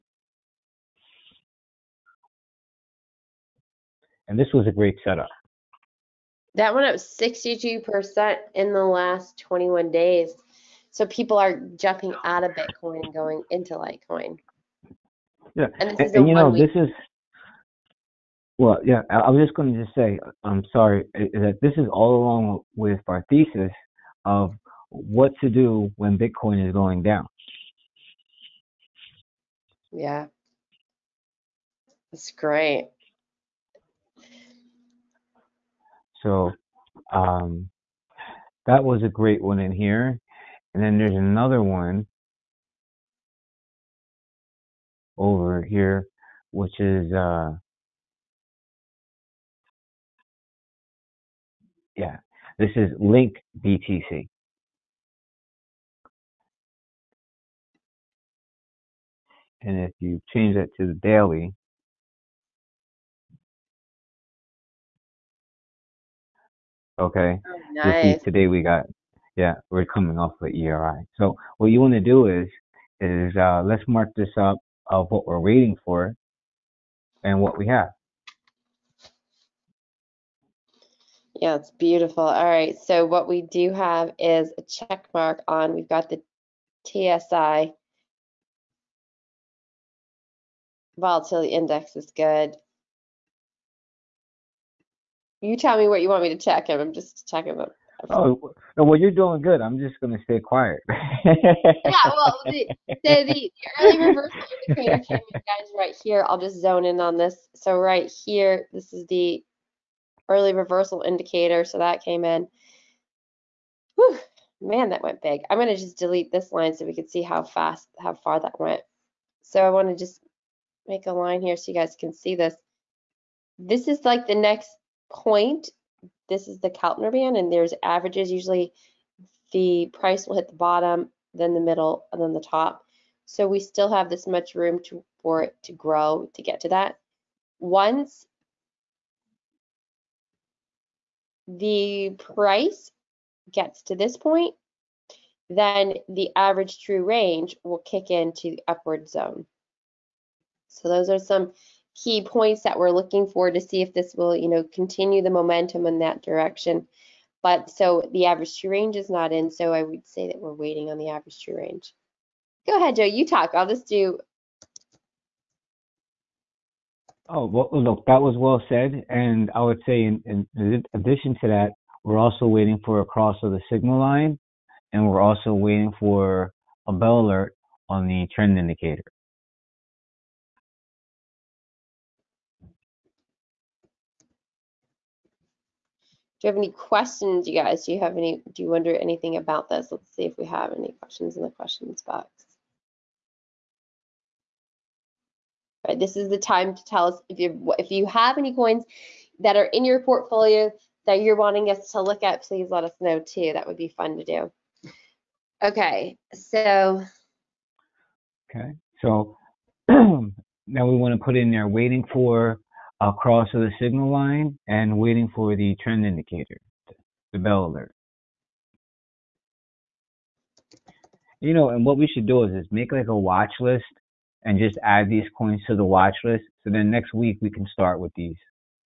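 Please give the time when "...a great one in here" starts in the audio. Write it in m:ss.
0:39.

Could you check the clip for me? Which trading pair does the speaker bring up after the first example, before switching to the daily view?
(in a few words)
Link BTC.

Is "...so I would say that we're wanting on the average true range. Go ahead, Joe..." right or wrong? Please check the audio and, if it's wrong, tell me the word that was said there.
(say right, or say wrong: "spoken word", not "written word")
wrong: "waiting", not "wanting".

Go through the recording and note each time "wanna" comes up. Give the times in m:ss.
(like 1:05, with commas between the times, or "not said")
1:59.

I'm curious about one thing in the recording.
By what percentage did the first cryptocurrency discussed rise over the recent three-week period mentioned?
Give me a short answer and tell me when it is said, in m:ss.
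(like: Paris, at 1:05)
62%, at 0:06.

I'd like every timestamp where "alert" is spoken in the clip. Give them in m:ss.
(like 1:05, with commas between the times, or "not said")
2:57, 3:37.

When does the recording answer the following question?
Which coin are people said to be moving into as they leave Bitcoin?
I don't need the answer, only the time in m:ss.
0:13.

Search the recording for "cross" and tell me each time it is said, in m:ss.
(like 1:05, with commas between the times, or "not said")
2:53, 3:33.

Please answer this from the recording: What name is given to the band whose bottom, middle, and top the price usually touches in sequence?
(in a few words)
Keltner band.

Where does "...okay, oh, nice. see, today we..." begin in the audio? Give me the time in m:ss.
1:06.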